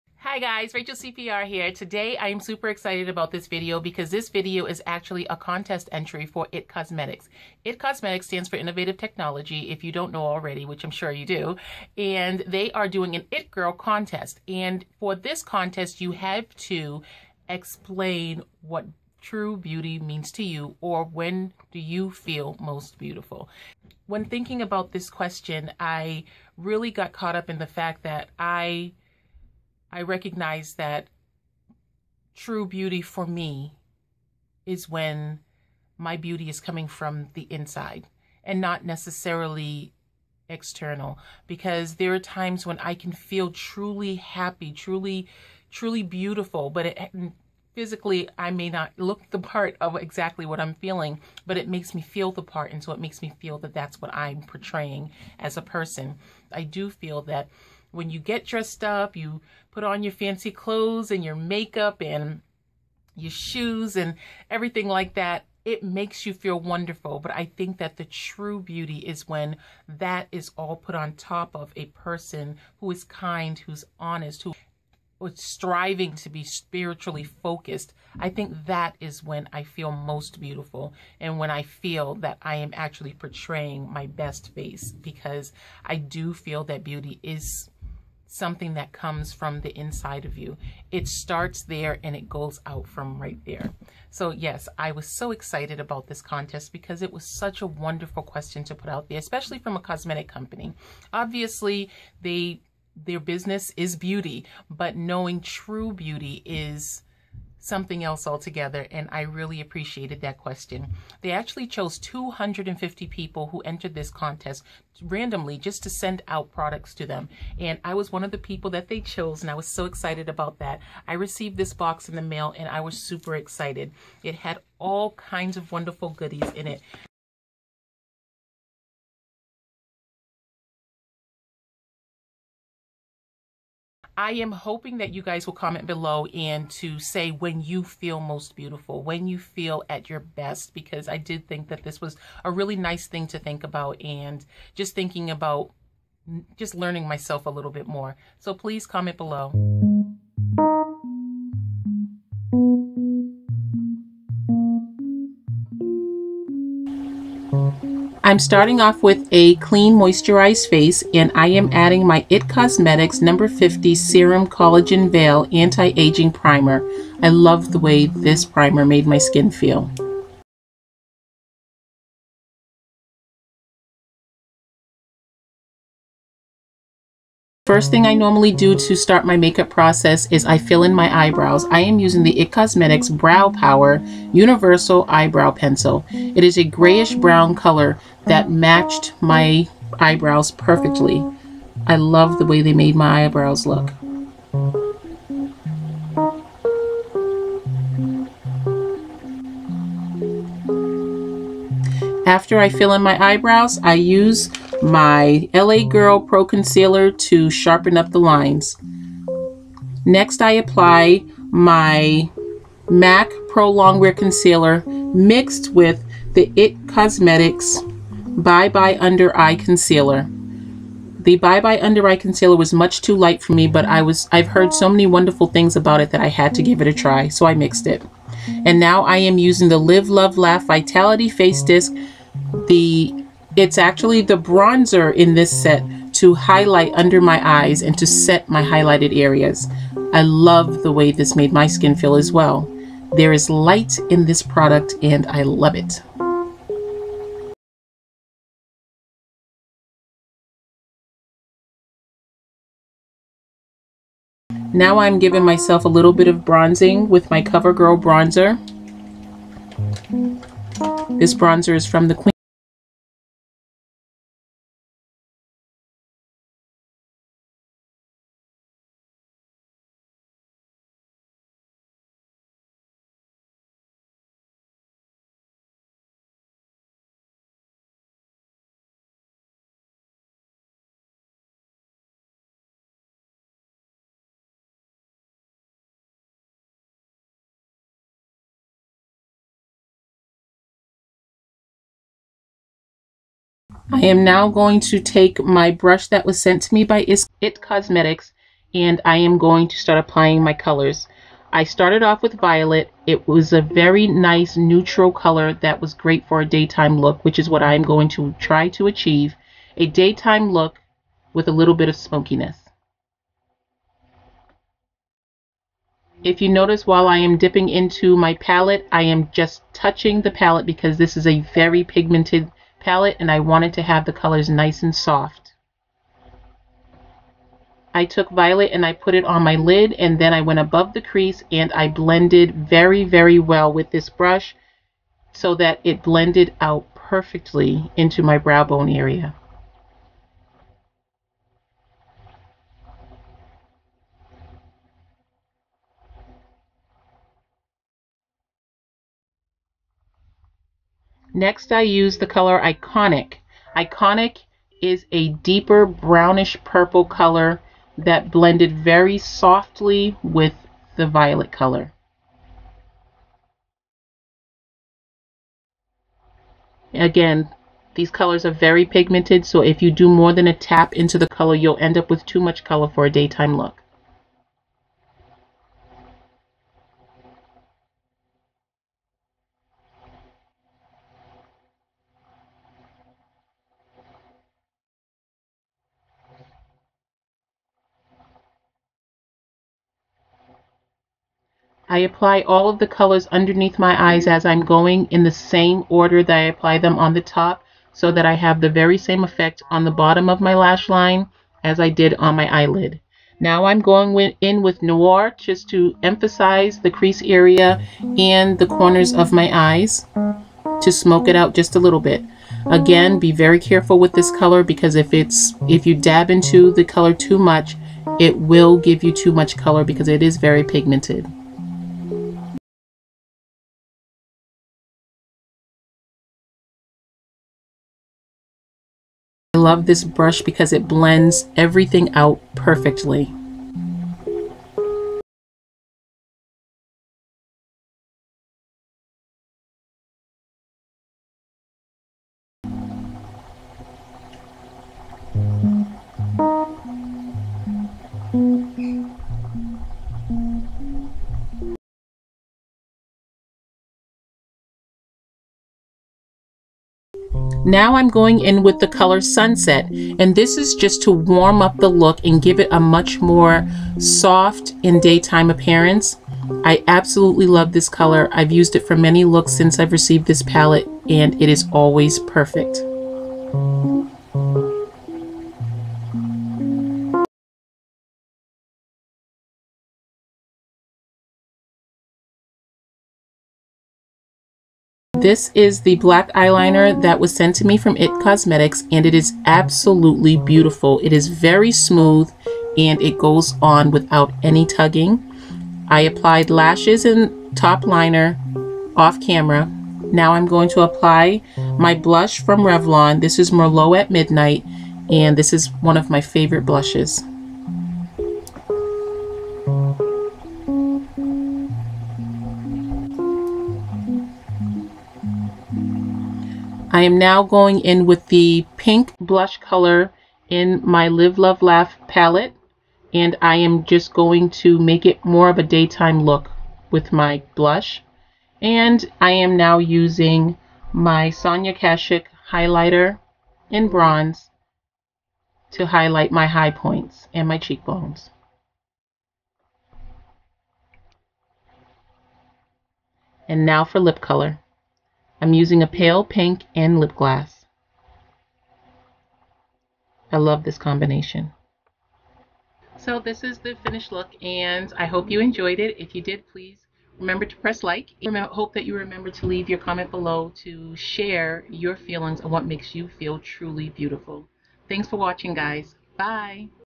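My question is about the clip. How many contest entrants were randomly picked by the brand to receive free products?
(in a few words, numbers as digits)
250.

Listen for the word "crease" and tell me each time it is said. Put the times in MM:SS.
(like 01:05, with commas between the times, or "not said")
05:31, 06:46.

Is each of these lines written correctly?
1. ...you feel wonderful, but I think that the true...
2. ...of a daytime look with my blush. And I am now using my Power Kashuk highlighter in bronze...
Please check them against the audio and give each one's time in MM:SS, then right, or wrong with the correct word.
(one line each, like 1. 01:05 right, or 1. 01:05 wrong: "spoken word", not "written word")
1. 01:06 right
2. 08:45 wrong: "Sonia", not "Power".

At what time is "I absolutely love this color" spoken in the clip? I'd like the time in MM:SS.
07:46.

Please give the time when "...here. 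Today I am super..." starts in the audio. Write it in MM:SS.
00:01.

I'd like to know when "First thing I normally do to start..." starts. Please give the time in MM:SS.
02:57.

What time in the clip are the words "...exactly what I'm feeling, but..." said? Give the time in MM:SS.
00:49.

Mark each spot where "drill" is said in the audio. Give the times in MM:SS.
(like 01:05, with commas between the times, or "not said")
not said.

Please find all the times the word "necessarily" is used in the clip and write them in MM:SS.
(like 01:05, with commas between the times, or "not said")
00:38.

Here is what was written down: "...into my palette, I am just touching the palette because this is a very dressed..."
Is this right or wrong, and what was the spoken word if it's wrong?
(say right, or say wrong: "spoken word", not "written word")
wrong: "pigmented", not "dressed".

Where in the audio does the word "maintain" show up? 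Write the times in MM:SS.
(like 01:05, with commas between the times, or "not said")
not said.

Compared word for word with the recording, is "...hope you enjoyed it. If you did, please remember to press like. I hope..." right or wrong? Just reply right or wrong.
right.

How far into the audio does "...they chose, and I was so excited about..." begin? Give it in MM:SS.
01:58.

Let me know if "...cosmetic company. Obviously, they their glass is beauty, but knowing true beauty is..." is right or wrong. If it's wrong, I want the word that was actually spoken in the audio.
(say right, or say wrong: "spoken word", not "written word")
wrong: "business", not "glass".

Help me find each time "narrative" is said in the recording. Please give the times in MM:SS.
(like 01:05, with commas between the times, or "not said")
not said.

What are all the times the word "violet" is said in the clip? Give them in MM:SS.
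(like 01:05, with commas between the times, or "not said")
05:02, 05:28, 06:01.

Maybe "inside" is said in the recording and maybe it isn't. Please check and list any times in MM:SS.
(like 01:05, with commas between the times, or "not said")
00:37, 01:29.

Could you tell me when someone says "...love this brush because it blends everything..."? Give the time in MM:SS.
07:09.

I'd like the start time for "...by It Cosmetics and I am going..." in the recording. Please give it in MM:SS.
04:56.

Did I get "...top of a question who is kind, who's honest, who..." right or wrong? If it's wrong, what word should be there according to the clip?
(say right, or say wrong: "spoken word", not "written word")
wrong: "person", not "question".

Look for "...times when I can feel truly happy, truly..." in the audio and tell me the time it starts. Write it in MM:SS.
00:42.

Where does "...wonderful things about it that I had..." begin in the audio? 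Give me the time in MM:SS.
03:45.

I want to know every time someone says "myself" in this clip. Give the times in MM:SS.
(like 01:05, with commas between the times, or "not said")
02:27, 04:15.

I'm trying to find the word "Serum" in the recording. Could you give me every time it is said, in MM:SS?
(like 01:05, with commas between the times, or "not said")
02:43.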